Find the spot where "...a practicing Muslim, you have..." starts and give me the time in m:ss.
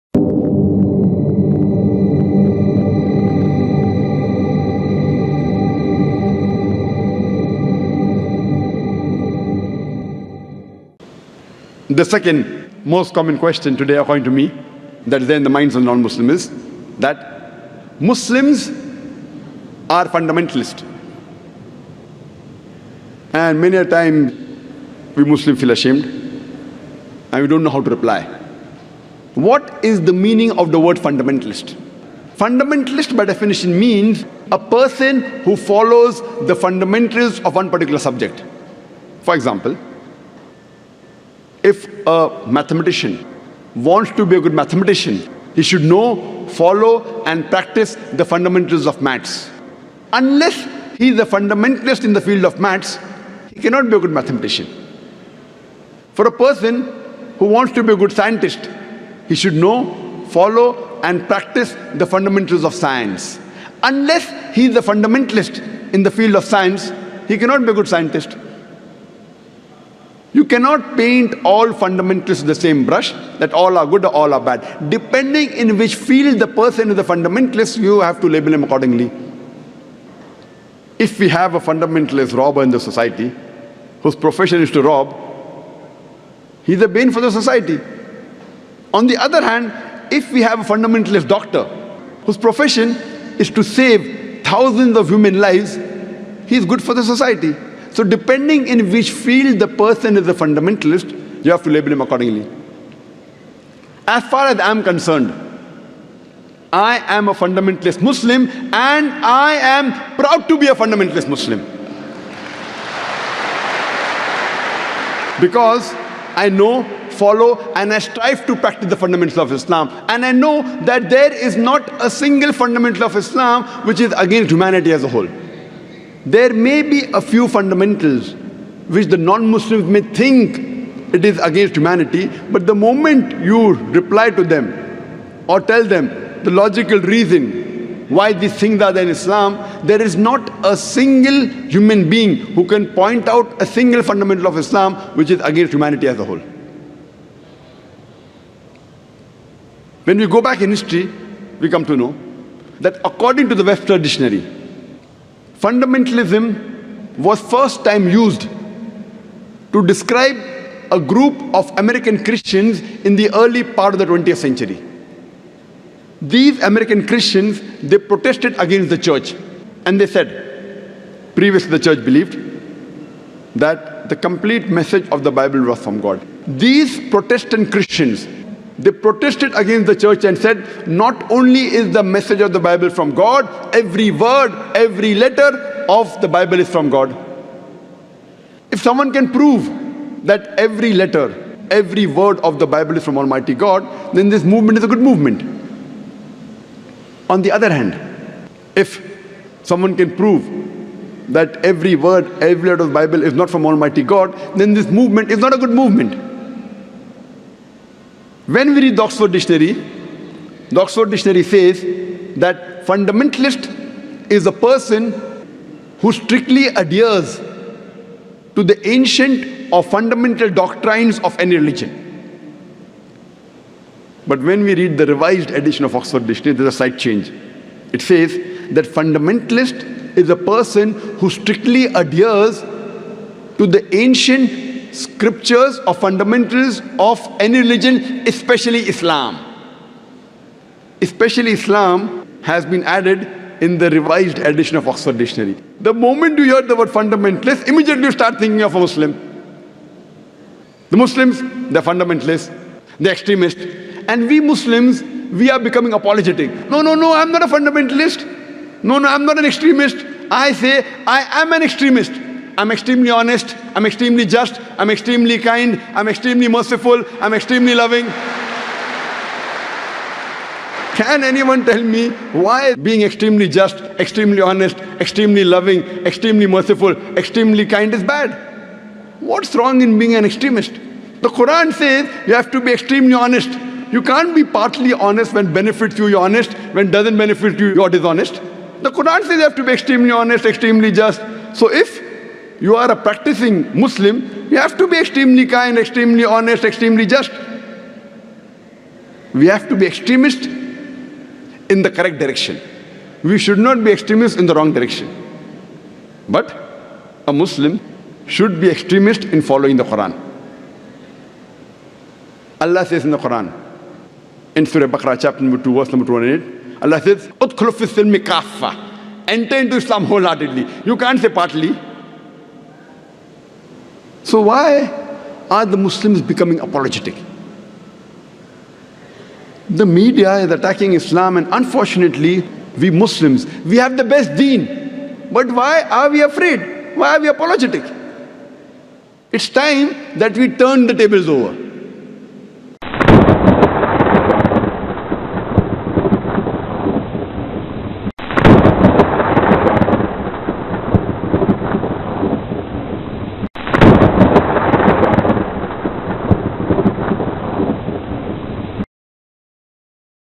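4:52.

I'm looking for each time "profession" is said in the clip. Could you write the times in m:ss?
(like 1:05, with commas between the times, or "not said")
1:24, 1:32.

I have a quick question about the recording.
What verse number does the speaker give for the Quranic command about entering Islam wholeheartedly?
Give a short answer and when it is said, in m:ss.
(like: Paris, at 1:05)
28, at 5:16.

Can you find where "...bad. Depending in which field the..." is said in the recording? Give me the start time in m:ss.
1:14.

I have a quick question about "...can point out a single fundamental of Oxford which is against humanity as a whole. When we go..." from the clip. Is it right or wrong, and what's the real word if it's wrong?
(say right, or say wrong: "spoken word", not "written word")
wrong: "Islam", not "Oxford".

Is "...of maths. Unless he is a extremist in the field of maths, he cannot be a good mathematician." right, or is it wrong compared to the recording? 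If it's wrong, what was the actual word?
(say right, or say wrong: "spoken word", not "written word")
wrong: "fundamentalist", not "extremist".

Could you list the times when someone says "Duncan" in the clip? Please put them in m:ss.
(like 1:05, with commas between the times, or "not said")
not said.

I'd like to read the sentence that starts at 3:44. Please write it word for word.
But when we read the revised edition of Oxford Dictionary, there's a slight change.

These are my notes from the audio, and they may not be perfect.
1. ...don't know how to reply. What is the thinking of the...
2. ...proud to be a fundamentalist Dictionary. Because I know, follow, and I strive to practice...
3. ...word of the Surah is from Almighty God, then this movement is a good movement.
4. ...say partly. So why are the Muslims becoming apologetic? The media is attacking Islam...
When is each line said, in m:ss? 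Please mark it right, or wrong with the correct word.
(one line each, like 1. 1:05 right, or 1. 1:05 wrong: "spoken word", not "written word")
1. 0:27 wrong: "meaning", not "thinking"
2. 1:50 wrong: "Muslim", not "Dictionary"
3. 3:12 wrong: "Bible", not "Surah"
4. 5:21 right.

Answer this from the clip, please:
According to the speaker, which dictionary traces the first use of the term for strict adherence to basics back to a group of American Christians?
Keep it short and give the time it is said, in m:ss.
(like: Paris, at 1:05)
Webster Dictionary, at 2:33.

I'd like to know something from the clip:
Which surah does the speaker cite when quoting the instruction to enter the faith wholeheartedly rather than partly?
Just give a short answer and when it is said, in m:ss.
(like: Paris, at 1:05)
Surah Baqarah, at 5:14.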